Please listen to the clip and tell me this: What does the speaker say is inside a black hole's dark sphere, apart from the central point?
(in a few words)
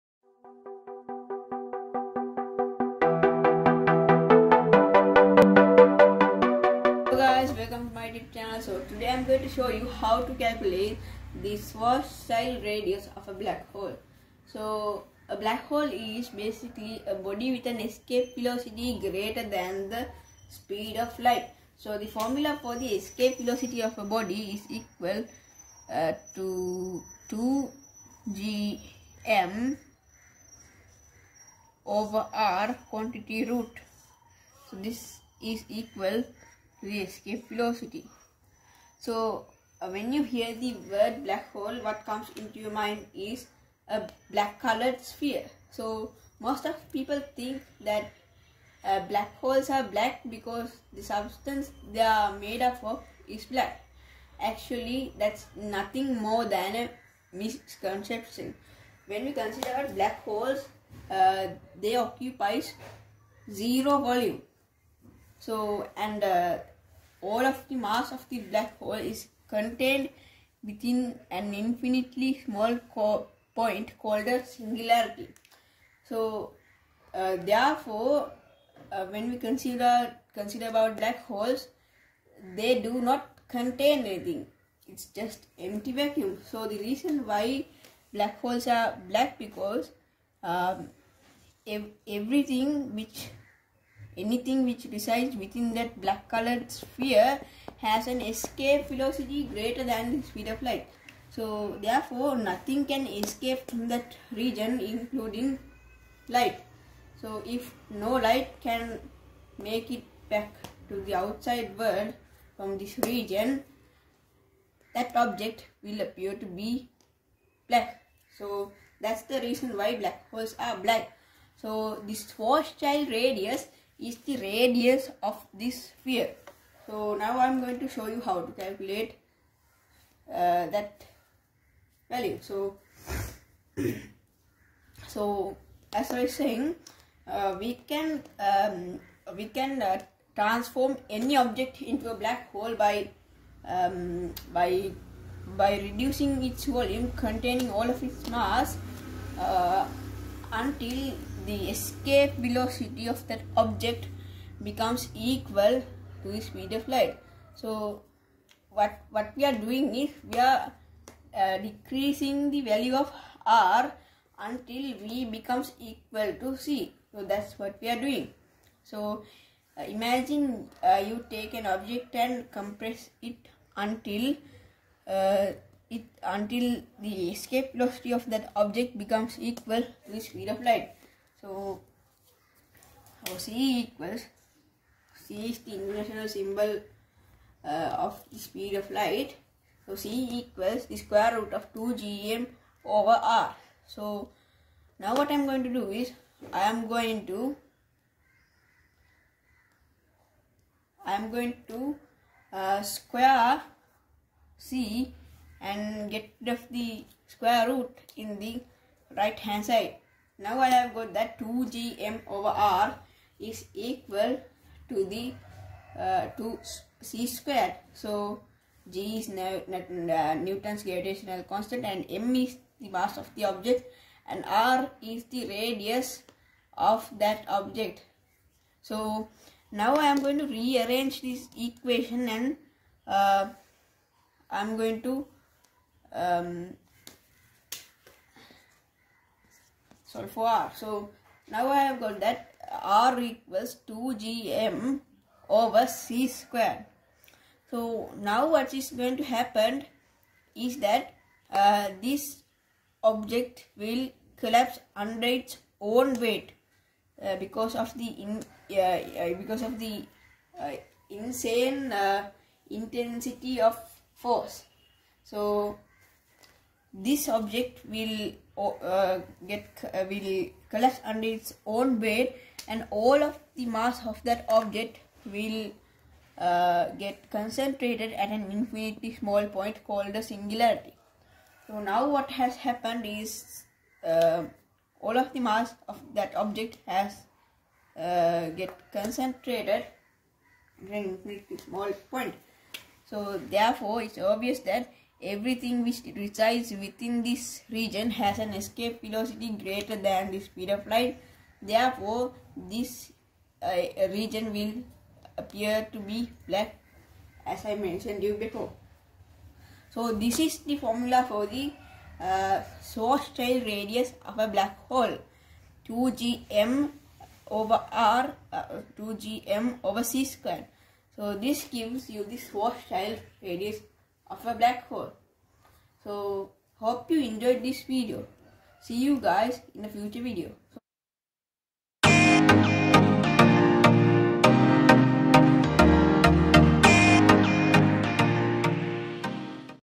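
Empty vacuum.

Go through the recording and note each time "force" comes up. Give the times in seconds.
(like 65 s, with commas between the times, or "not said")
264 s.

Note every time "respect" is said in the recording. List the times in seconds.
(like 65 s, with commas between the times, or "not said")
not said.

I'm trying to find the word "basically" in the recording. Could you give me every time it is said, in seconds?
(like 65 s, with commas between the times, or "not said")
16 s.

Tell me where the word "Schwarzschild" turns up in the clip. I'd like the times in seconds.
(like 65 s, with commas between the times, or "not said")
11 s, 122 s, 312 s.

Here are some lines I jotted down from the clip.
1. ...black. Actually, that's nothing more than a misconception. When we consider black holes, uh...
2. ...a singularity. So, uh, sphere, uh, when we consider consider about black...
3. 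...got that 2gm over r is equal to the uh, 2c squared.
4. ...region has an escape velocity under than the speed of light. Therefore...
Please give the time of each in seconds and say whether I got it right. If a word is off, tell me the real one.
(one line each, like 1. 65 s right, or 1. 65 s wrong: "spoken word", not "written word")
1. 53 s right
2. 74 s wrong: "therefore", not "sphere"
3. 210 s right
4. 297 s wrong: "greater", not "under".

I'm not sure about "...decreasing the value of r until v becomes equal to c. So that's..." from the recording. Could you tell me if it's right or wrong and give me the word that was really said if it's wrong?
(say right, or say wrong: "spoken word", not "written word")
right.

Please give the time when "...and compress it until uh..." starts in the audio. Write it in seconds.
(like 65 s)
172 s.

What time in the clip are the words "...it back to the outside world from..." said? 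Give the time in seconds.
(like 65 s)
109 s.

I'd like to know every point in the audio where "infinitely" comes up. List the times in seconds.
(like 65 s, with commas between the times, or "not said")
71 s, 278 s, 291 s.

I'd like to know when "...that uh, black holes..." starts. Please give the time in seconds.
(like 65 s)
47 s.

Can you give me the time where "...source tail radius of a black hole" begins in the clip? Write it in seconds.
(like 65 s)
322 s.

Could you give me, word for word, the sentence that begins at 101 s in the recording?
So therefore nothing can escape from that region including light.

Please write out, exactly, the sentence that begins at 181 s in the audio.
So, so c equals c is the international symbol uh, of the speed of light.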